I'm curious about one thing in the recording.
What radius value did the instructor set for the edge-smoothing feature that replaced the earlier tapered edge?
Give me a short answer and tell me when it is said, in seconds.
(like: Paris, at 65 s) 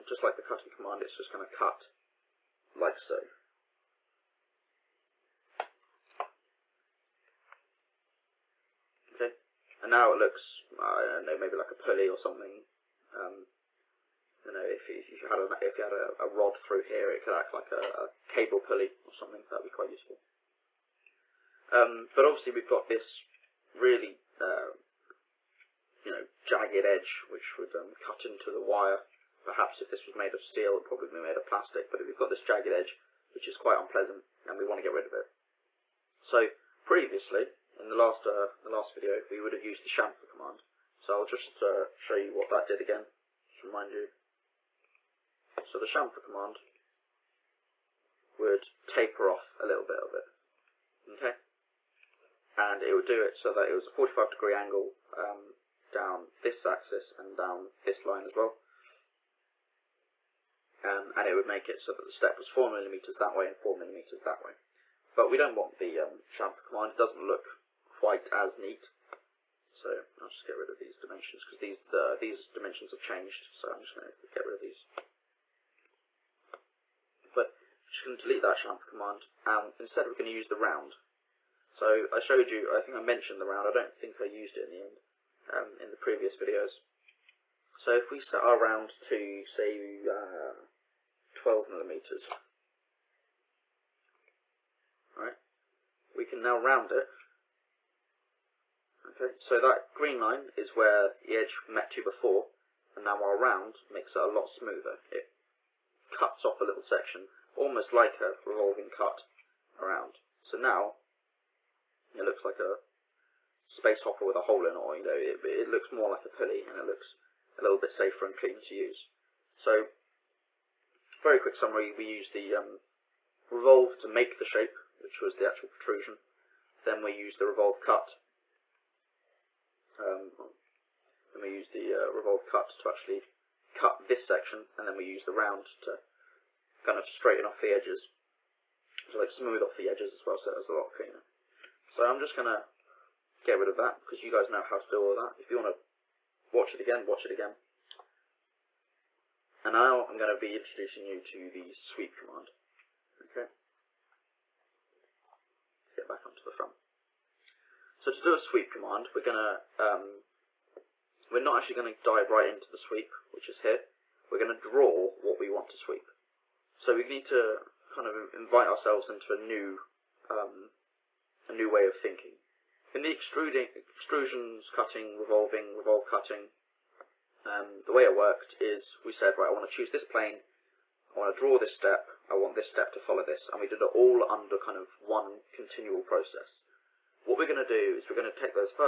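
12 millimeters, at 91 s.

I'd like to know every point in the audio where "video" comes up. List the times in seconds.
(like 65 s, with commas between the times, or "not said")
38 s, 86 s.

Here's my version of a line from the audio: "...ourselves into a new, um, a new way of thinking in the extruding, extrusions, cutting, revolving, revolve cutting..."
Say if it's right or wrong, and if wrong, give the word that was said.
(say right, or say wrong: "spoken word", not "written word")
right.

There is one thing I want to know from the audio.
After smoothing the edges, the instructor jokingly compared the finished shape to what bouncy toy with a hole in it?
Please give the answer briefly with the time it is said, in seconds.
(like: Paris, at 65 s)
space hopper, at 113 s.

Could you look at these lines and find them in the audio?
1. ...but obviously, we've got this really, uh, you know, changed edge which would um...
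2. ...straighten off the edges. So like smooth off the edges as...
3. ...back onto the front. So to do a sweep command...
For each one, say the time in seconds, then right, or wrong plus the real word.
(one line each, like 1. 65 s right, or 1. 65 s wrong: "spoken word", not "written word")
1. 22 s wrong: "jagged", not "changed"
2. 137 s right
3. 156 s right.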